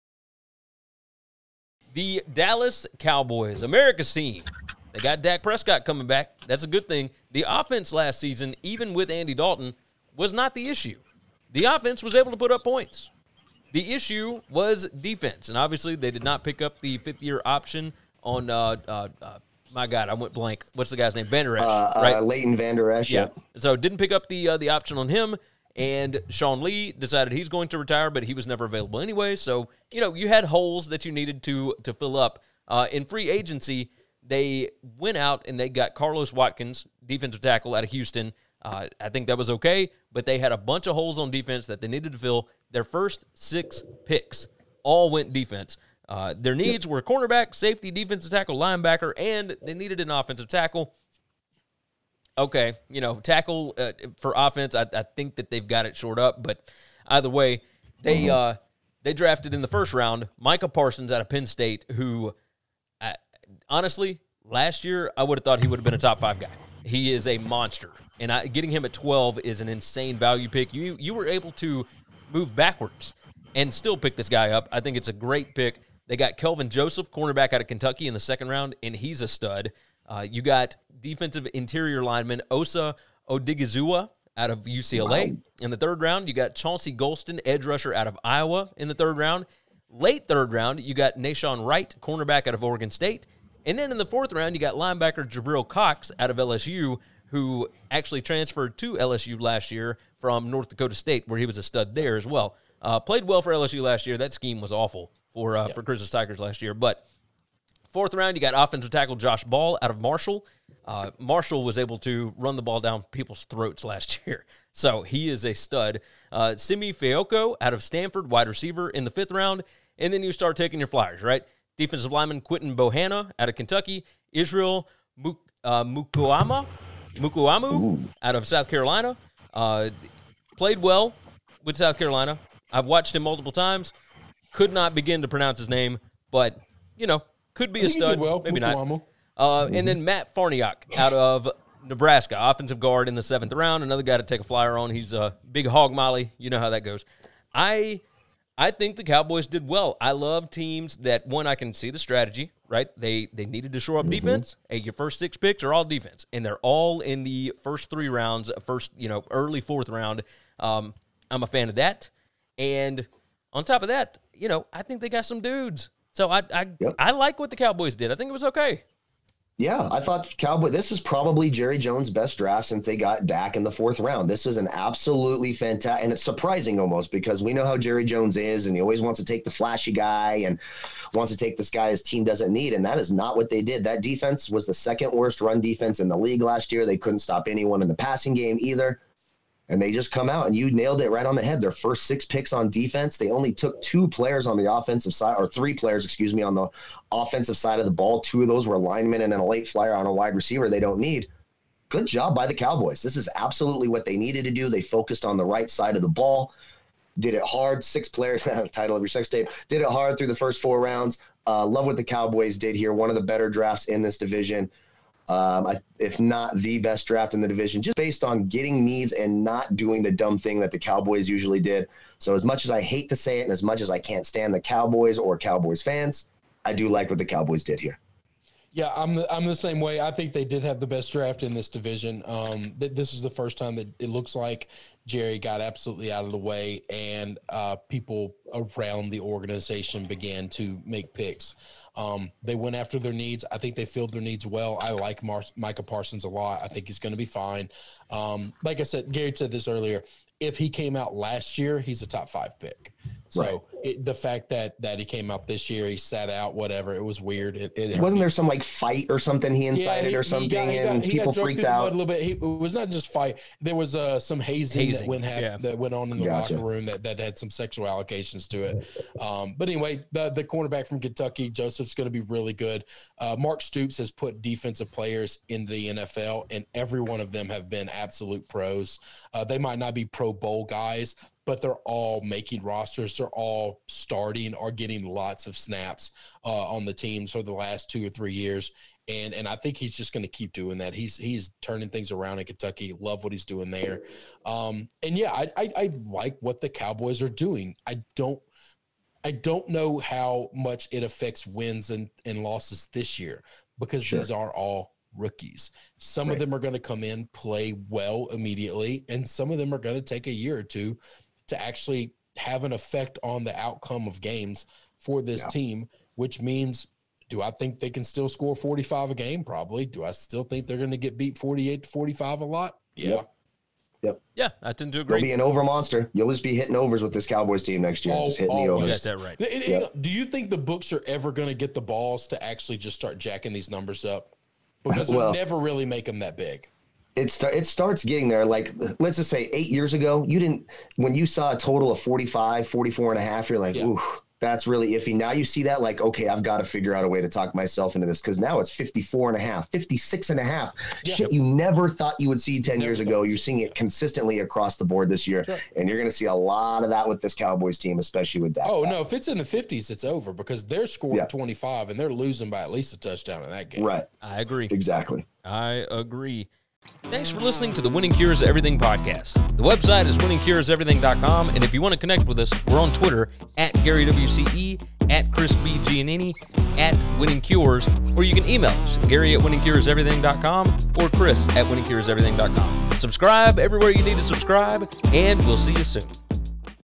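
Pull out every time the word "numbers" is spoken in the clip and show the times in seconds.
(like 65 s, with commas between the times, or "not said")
333 s.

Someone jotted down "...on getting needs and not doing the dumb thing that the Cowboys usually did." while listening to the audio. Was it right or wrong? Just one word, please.
right.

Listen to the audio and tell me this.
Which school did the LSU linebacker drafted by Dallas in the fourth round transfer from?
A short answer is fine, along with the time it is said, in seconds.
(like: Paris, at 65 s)
North Dakota State, at 100 s.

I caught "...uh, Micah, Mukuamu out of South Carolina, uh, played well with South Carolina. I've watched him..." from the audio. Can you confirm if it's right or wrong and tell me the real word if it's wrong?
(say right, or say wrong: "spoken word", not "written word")
wrong: "Mukuama", not "Micah".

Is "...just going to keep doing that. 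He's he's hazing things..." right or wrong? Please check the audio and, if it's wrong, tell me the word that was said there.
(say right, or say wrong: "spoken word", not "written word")
wrong: "turning", not "hazing".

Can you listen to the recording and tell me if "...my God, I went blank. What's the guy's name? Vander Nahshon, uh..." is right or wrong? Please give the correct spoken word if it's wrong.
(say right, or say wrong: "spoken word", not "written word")
wrong: "Esch", not "Nahshon".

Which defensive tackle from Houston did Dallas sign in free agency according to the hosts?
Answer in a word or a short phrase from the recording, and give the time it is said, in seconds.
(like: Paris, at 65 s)
Carlos Watkins, at 35 s.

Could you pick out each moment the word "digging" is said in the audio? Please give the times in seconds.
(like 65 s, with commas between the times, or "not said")
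not said.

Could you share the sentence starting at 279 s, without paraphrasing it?
Uh, they might not be Pro Bowl guys, but they're all making rosters.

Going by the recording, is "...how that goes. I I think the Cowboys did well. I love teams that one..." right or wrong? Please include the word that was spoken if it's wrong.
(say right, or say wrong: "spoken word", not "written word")
right.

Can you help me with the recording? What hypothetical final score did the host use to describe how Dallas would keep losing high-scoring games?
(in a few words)
48 to 45.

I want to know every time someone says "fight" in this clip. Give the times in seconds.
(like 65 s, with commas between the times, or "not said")
258 s, 263 s.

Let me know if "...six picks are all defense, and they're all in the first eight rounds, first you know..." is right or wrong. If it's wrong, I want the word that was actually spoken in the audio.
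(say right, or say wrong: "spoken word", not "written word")
wrong: "three", not "eight".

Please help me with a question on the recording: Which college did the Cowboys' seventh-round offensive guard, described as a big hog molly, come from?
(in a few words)
Nebraska.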